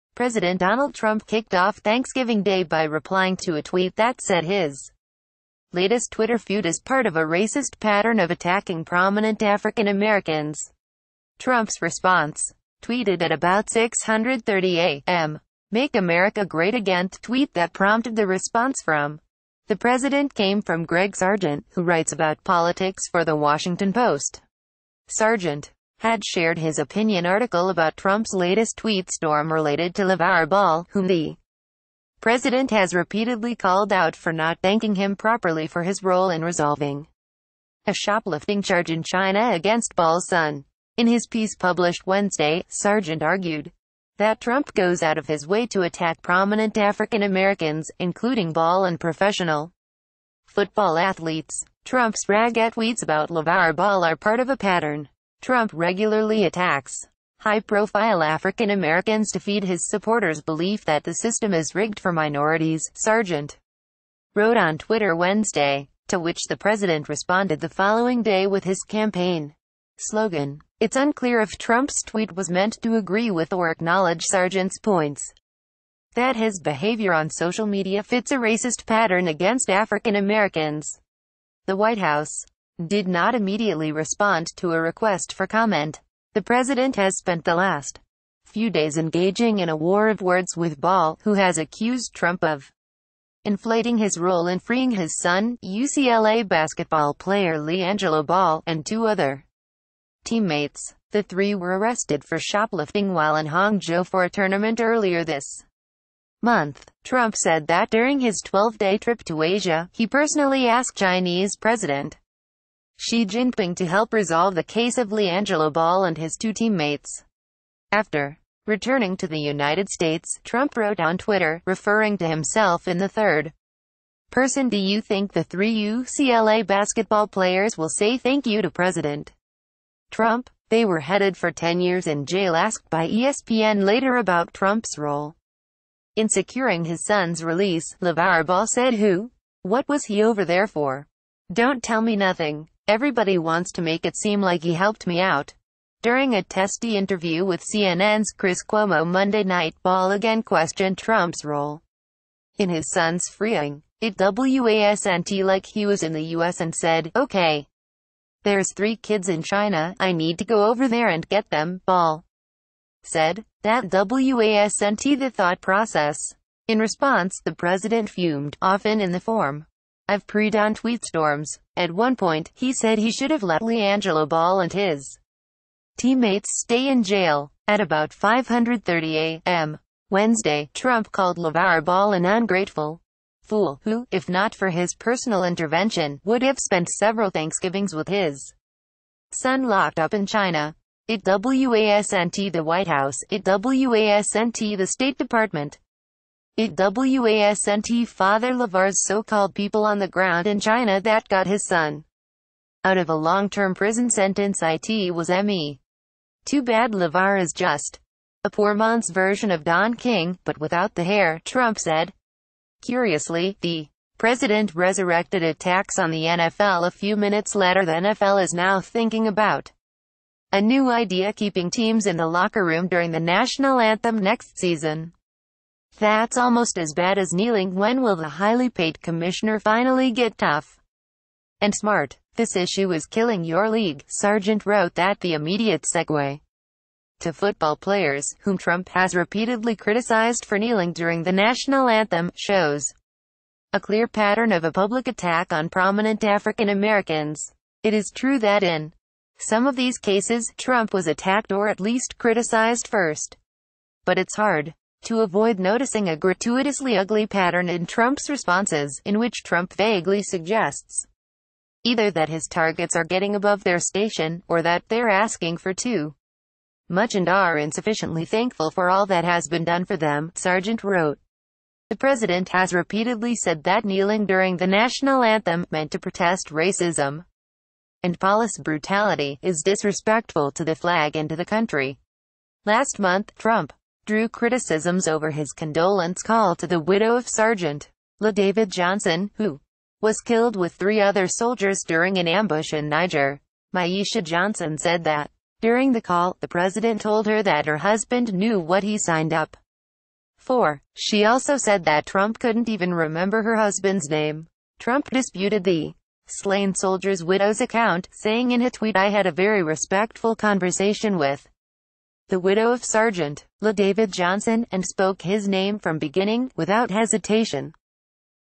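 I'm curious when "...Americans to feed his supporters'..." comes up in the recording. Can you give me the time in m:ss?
0:58.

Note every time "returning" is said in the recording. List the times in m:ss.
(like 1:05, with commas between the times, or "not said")
1:58.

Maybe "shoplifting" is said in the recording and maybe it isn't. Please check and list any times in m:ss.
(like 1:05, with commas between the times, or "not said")
0:37, 1:42.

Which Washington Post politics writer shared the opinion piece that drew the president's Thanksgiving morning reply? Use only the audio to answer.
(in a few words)
Greg Sargent.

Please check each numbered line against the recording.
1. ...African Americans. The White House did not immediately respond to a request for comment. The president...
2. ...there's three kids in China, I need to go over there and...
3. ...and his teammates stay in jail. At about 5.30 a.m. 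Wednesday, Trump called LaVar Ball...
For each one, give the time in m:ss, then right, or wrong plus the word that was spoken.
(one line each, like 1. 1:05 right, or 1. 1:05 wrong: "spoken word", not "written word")
1. 1:19 right
2. 2:38 right
3. 2:54 right.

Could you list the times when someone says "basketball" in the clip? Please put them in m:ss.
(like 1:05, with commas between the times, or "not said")
1:36, 2:06.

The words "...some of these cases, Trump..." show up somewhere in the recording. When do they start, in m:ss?
4:09.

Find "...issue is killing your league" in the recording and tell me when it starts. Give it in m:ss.
3:52.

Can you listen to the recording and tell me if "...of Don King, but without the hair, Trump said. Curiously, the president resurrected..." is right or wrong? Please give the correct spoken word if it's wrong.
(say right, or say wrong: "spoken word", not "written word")
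right.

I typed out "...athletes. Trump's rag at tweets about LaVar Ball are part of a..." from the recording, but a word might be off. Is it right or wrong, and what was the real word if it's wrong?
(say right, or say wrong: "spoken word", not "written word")
right.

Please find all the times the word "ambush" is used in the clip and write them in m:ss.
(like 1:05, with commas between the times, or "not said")
4:52.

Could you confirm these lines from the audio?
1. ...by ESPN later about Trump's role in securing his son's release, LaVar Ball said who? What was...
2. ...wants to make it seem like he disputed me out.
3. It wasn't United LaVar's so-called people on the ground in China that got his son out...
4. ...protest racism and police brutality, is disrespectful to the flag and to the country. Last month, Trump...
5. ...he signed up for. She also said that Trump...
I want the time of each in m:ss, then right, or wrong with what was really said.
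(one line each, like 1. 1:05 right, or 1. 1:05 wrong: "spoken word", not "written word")
1. 2:12 right
2. 2:23 wrong: "helped", not "disputed"
3. 3:16 wrong: "Father", not "United"
4. 4:35 right
5. 4:58 right.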